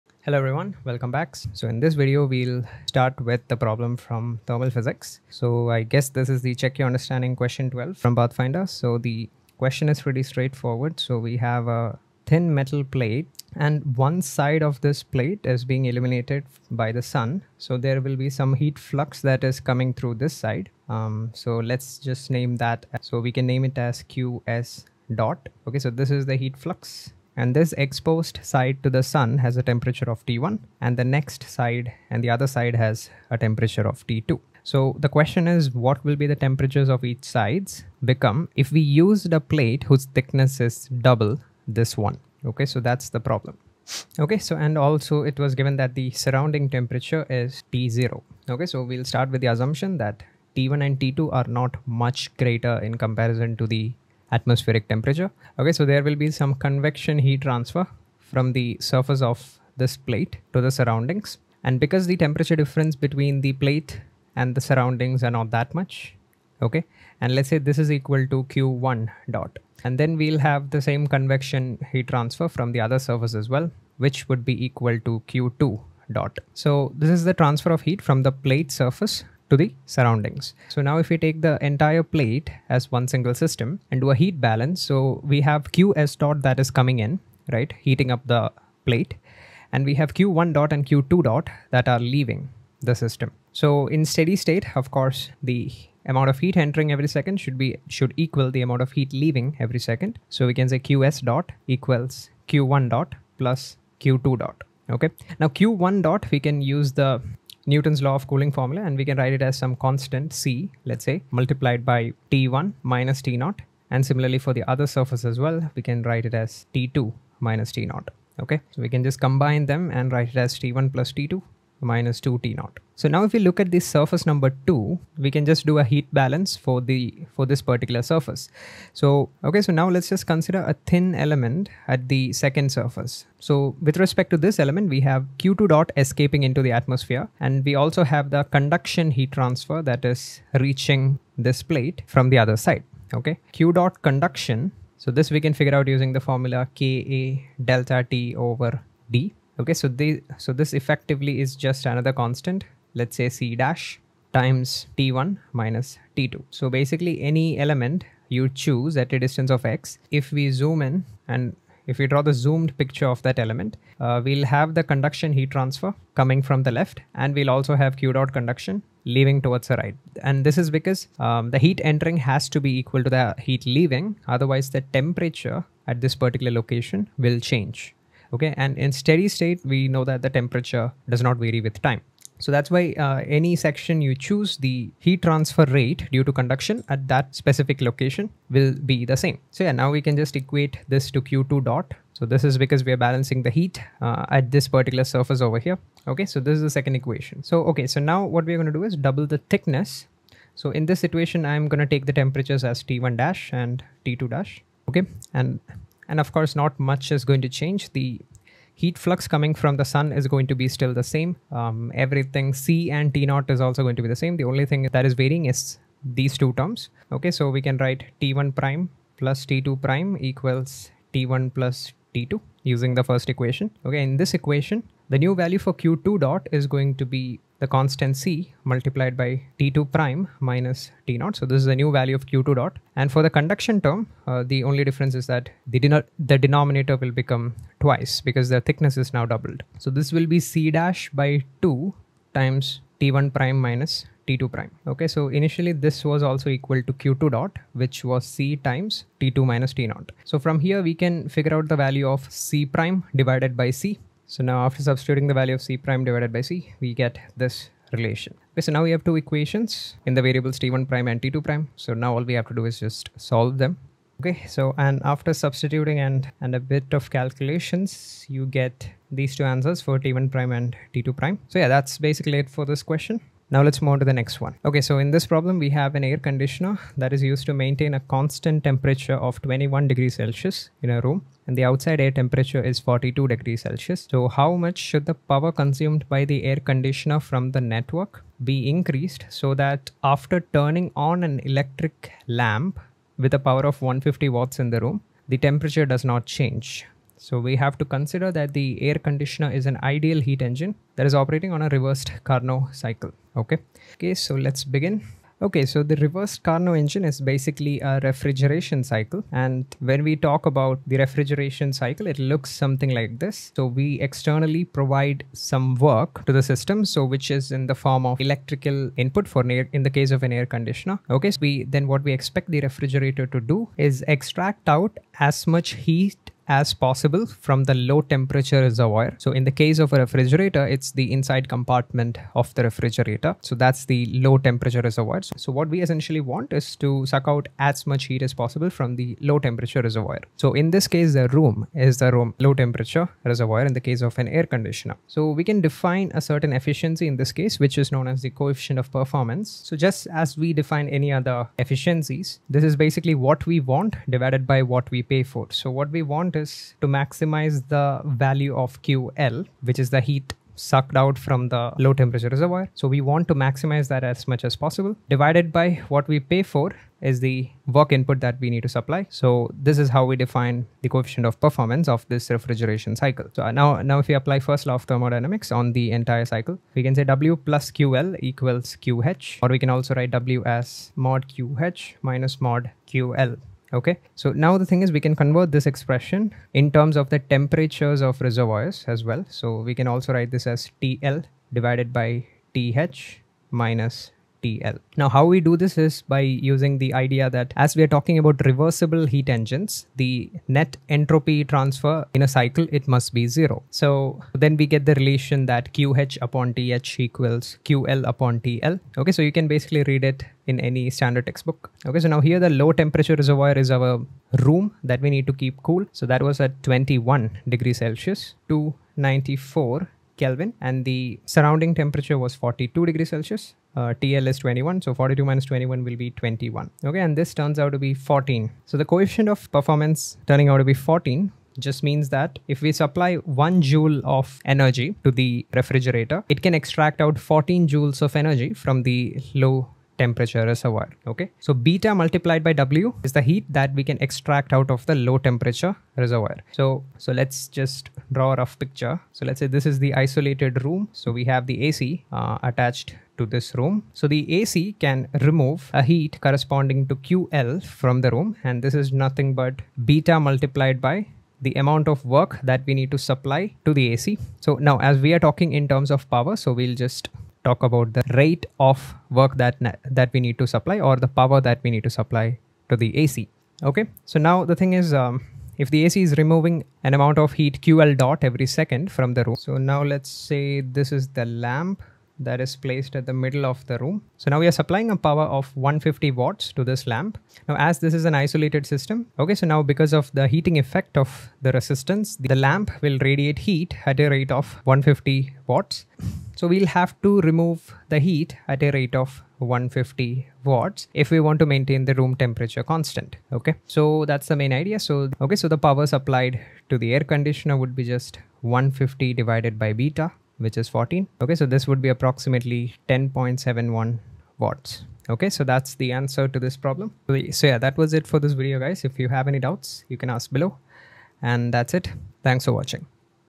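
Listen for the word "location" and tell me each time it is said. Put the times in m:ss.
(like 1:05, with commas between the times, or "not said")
2:56, 3:07.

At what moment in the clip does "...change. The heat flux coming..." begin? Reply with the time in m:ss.
3:27.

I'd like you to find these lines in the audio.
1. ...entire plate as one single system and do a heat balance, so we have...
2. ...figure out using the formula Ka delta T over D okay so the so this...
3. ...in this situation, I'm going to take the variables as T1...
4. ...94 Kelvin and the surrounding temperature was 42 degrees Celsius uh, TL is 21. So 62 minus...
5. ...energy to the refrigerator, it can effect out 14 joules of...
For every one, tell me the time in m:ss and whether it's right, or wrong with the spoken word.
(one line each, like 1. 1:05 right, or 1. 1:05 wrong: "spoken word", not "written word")
1. 1:21 right
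2. 2:25 right
3. 3:20 wrong: "temperatures", not "variables"
4. 6:58 wrong: "42", not "62"
5. 7:14 wrong: "extract", not "effect".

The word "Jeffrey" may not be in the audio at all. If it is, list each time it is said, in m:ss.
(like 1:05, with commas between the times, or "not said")
not said.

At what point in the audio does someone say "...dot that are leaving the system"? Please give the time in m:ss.
1:31.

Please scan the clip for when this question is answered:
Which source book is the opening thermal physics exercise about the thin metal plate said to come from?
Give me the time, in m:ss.
0:08.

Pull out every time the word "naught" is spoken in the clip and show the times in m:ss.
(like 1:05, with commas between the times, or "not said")
2:02, 3:33, 3:51, 4:09.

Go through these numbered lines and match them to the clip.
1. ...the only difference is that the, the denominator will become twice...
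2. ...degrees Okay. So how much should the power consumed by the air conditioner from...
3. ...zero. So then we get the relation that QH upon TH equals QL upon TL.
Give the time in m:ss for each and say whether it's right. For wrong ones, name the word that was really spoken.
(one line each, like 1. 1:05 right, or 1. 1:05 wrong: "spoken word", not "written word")
1. 3:54 right
2. 4:43 wrong: "Celsius", not "Okay"
3. 6:43 right.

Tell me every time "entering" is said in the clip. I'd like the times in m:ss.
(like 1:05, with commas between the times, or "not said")
1:36, 2:51.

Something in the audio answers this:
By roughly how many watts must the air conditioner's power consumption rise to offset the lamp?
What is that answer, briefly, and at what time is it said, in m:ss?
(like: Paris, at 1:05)
10.71 watts, at 8:32.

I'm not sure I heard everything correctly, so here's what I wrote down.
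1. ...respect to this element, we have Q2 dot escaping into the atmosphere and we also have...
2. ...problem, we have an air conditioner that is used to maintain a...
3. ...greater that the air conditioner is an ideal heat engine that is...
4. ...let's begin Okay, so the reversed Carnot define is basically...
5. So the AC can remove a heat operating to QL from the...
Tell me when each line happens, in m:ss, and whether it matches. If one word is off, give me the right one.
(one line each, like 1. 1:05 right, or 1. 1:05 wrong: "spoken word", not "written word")
1. 2:13 right
2. 4:35 right
3. 4:57 wrong: "consider", not "greater"
4. 5:04 wrong: "engine", not "define"
5. 7:33 wrong: "corresponding", not "operating".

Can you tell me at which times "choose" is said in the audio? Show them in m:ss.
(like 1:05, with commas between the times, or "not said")
2:38, 3:04.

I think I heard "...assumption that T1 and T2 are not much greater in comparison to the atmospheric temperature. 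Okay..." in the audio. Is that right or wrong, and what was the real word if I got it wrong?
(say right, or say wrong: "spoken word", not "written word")
right.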